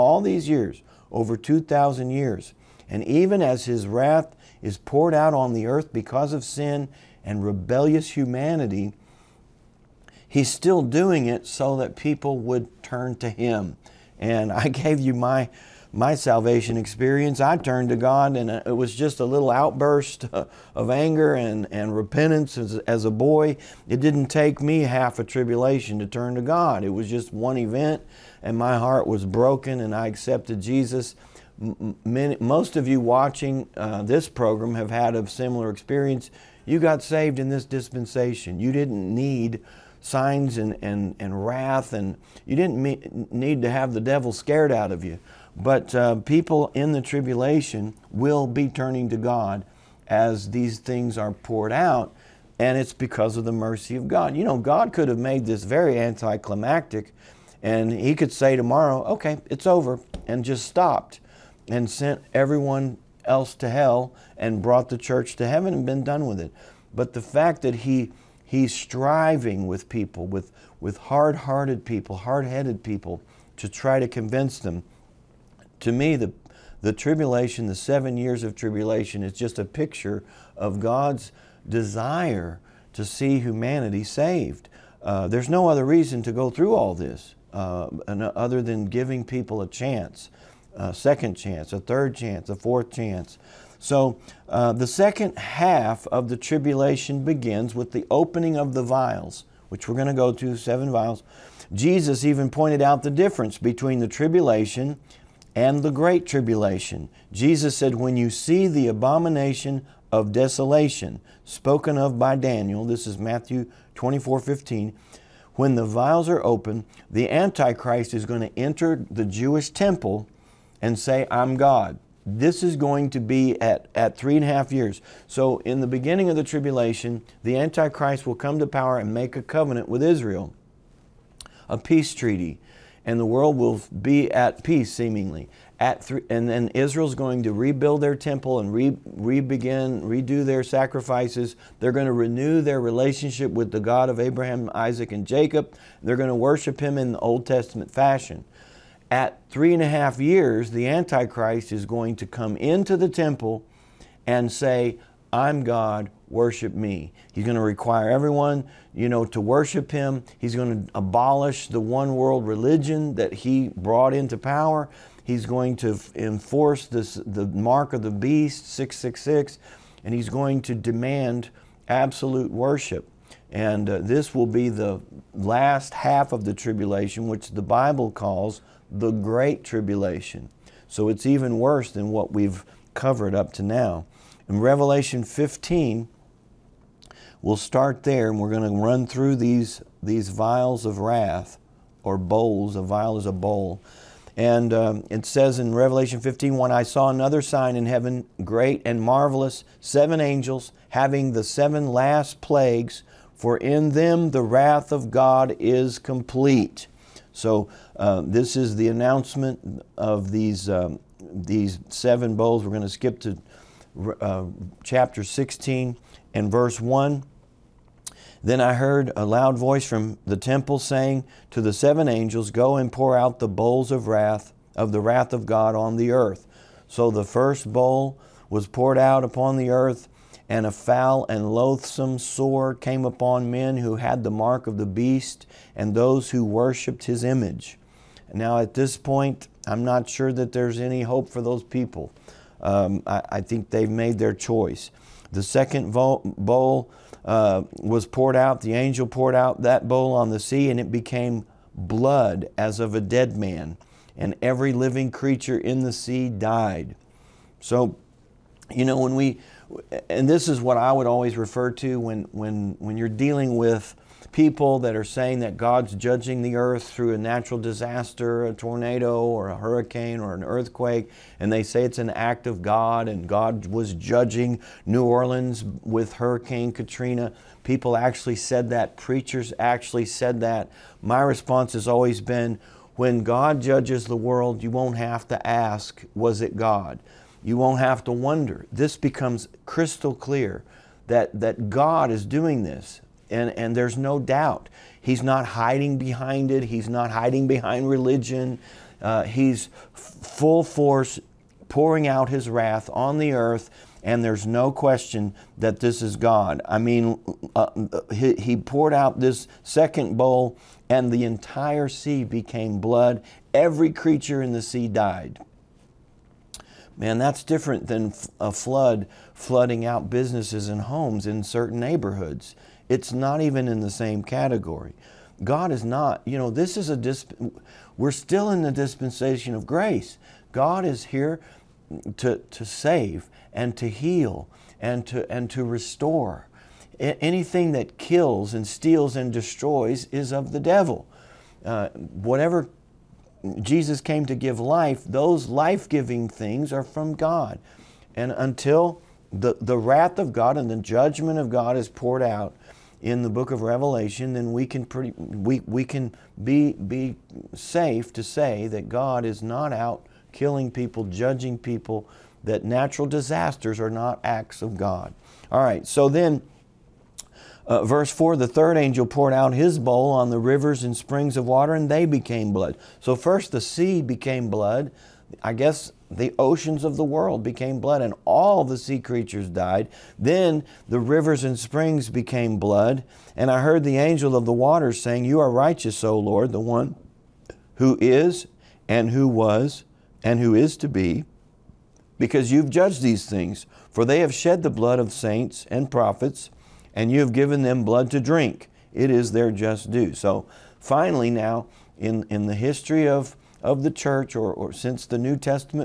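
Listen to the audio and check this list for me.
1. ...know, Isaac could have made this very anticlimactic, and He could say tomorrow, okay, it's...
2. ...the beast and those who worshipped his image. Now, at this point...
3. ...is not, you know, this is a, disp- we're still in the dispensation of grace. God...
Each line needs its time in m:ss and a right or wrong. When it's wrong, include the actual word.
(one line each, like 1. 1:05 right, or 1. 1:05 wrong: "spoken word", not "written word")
1. 0:54 wrong: "God", not "Isaac"
2. 3:54 right
3. 5:25 right.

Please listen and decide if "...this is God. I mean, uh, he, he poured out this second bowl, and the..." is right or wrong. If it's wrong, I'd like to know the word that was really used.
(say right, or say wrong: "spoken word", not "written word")
right.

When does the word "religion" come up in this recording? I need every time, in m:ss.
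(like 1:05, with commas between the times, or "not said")
2:42, 4:57.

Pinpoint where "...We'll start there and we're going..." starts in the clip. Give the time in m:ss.
3:07.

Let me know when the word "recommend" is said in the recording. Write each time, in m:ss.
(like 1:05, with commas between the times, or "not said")
not said.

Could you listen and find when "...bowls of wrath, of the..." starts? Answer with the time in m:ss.
3:43.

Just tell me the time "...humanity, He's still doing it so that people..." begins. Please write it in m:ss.
0:08.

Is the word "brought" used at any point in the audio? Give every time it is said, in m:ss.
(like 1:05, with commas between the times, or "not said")
1:04, 2:43.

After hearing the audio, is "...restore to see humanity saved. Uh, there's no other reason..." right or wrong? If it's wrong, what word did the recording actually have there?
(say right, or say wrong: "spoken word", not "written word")
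wrong: "desire", not "restore".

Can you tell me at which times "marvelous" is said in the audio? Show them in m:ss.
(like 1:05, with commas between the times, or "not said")
3:19.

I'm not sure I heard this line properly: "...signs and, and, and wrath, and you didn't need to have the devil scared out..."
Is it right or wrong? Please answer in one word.
right.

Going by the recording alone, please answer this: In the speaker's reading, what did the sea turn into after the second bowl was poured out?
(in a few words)
blood as of a dead man.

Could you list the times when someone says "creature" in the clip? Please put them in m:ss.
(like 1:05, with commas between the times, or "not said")
4:15, 5:13, 6:18.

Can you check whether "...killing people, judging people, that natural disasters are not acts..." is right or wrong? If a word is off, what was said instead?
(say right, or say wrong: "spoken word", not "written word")
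right.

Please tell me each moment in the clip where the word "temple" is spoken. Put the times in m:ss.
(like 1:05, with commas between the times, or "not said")
1:59, 2:18, 2:33, 3:40.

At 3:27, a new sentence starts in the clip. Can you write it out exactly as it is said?
So uh, this is the announcement of these, um, these seven bowls.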